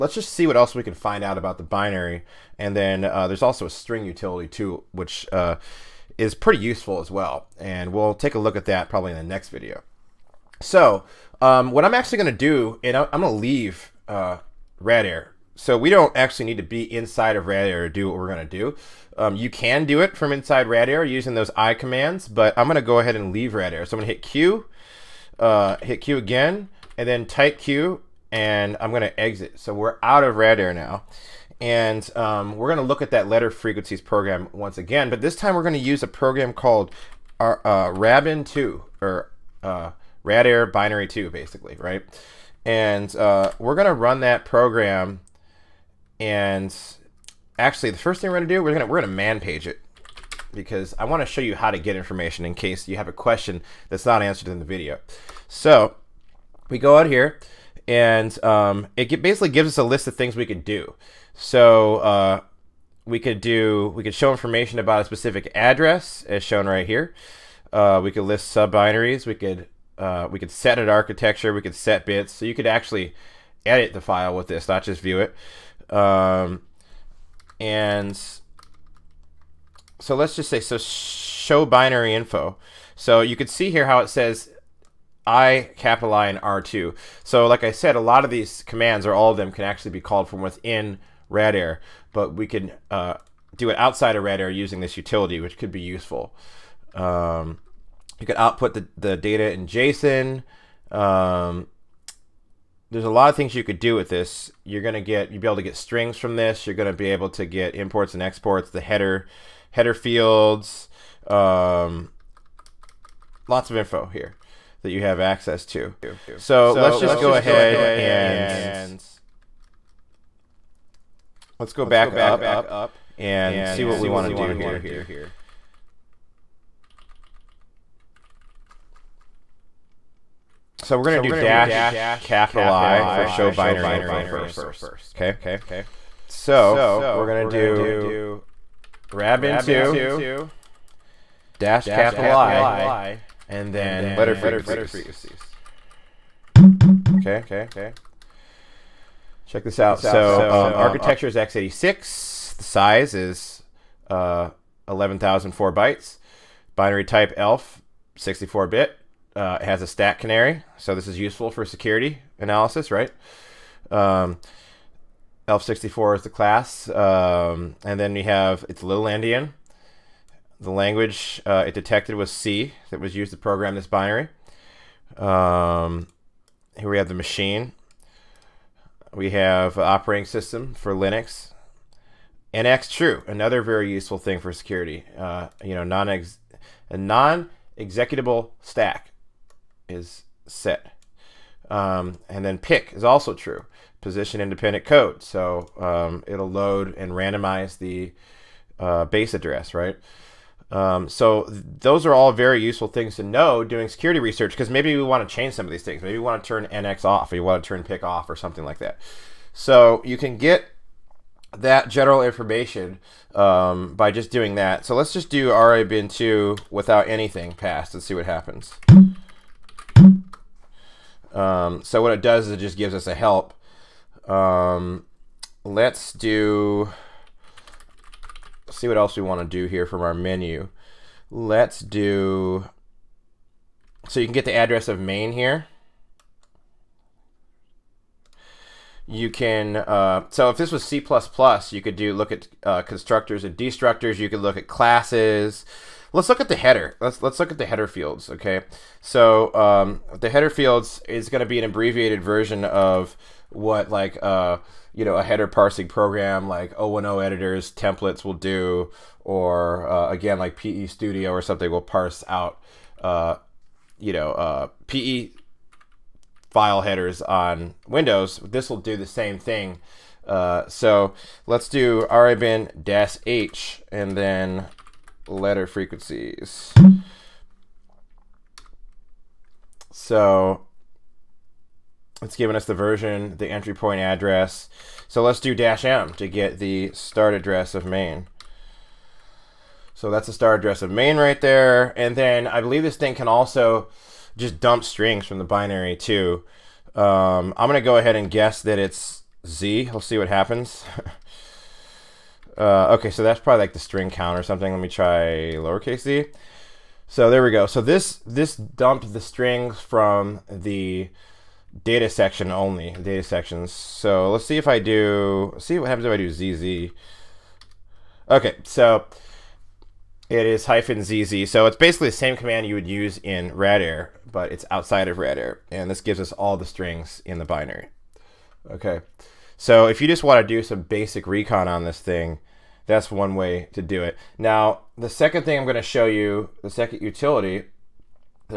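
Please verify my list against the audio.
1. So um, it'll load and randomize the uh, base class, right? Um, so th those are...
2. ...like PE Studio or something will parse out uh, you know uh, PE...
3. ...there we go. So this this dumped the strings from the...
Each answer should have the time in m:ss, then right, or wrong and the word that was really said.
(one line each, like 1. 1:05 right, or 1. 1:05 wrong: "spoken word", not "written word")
1. 3:15 wrong: "address", not "class"
2. 4:20 right
3. 5:07 right.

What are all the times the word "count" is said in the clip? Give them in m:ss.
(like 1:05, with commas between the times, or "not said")
5:04.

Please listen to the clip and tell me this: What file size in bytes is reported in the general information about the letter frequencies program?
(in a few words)
11,004 bytes.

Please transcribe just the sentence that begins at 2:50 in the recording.
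The language uh, it detected was C that was used to program this binary.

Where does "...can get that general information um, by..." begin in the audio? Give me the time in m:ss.
3:30.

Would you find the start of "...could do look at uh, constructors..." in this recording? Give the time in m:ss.
4:01.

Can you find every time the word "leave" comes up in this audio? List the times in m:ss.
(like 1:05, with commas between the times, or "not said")
0:13, 0:23.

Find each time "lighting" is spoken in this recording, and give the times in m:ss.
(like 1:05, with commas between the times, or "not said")
not said.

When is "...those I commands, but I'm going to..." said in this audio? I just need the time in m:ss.
0:21.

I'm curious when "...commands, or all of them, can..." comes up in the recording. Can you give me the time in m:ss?
1:28.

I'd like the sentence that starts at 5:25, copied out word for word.
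And this gives us all the strings in the binary.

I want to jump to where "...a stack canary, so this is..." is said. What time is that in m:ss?
2:39.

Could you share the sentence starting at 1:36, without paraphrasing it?
Um, you could output the, the data in JSON.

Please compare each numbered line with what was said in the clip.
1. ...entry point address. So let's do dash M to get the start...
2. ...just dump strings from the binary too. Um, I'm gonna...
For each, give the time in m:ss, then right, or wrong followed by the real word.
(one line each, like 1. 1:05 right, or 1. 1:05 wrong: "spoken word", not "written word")
1. 4:43 right
2. 4:54 right.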